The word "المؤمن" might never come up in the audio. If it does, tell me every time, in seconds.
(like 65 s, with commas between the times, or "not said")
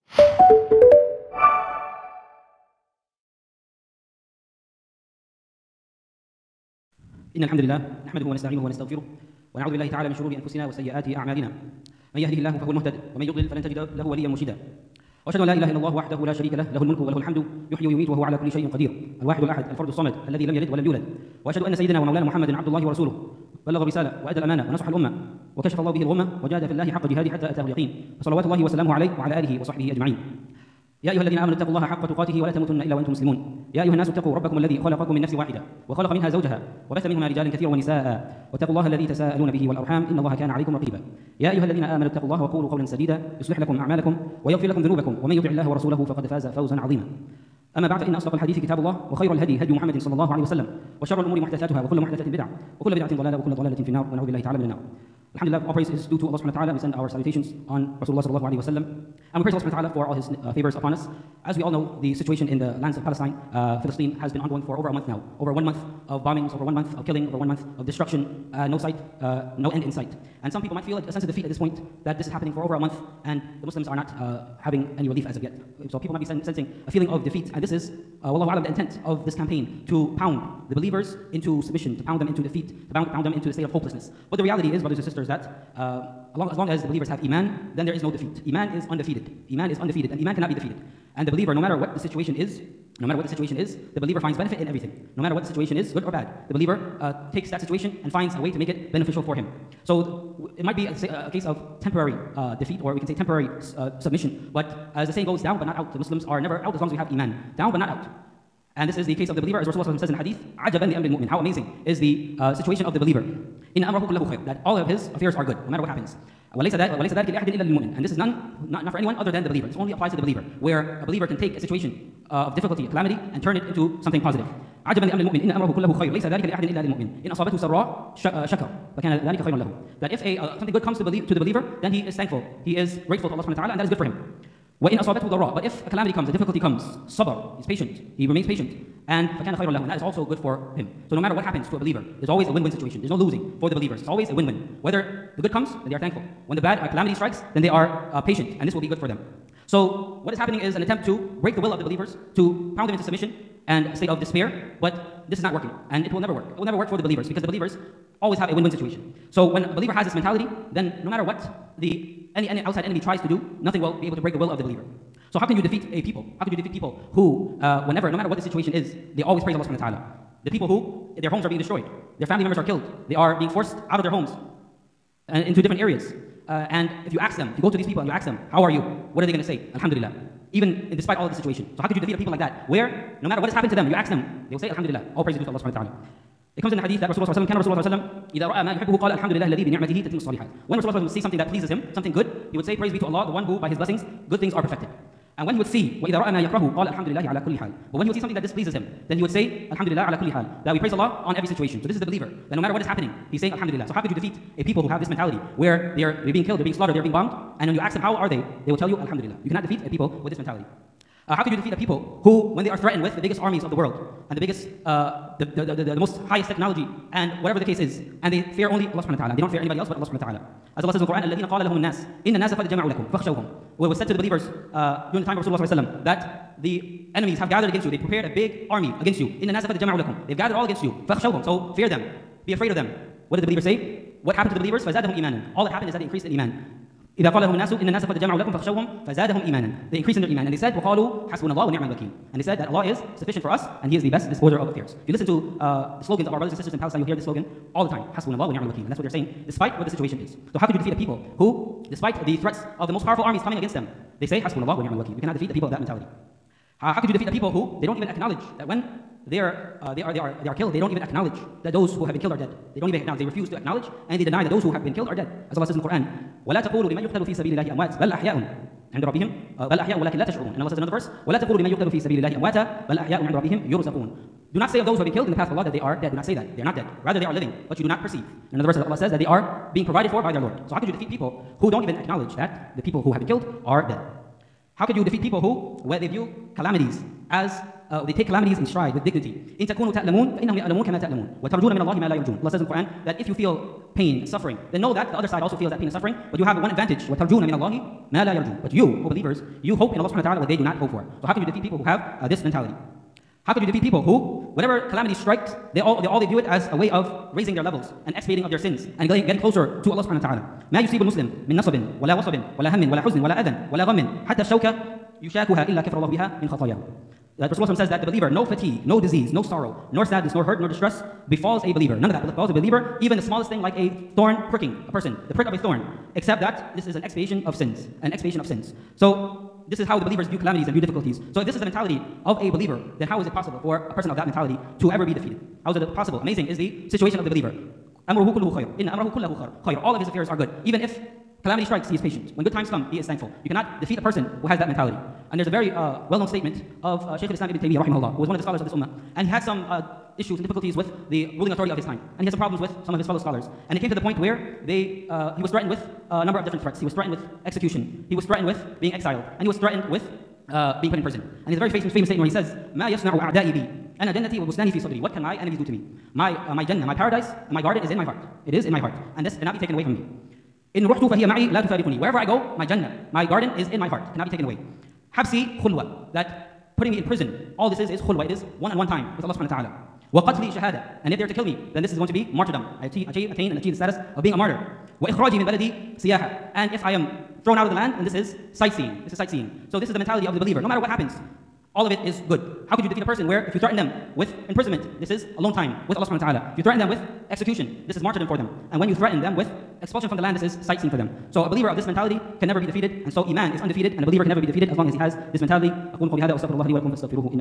111 s, 125 s.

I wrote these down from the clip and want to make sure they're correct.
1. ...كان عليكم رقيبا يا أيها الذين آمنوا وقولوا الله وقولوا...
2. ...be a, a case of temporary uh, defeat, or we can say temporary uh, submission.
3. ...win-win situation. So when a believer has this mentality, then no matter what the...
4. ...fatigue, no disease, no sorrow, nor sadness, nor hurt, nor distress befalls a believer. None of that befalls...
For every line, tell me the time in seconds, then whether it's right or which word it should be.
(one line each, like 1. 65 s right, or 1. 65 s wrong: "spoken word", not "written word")
1. 40 s wrong: "اتقوا", not "وقولوا"
2. 100 s right
3. 158 s right
4. 318 s right.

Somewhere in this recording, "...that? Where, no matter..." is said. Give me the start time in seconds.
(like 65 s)
182 s.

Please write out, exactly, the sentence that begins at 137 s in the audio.
he's patient, he remains patient, and فَكَانَ خَيْرًا لَهُ And that is also good for him.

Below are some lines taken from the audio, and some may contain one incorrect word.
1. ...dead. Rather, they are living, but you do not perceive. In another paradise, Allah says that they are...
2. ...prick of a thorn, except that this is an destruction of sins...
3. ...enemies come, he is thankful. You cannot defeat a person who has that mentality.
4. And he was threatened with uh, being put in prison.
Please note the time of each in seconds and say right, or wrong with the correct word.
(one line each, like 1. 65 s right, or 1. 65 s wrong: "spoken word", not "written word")
1. 276 s wrong: "verse", not "paradise"
2. 325 s wrong: "expiation", not "destruction"
3. 342 s wrong: "times", not "enemies"
4. 359 s right.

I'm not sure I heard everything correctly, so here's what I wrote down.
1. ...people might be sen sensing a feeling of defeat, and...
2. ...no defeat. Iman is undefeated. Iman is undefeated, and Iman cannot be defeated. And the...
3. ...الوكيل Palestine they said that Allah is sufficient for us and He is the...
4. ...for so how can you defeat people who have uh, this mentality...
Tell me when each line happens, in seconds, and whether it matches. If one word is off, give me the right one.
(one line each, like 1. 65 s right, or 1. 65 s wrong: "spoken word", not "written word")
1. 75 s right
2. 88 s right
3. 241 s wrong: "And", not "Palestine"
4. 300 s right.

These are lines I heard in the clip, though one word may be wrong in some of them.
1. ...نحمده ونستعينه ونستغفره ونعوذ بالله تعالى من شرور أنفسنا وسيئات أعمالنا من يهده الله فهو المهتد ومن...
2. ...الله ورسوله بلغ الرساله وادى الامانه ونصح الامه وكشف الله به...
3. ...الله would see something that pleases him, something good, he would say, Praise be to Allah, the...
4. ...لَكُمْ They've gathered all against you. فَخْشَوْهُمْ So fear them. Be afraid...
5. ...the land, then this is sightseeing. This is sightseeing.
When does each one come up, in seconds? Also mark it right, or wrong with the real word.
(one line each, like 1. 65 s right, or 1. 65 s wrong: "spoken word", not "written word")
1. 8 s right
2. 22 s right
3. 191 s right
4. 230 s right
5. 387 s right.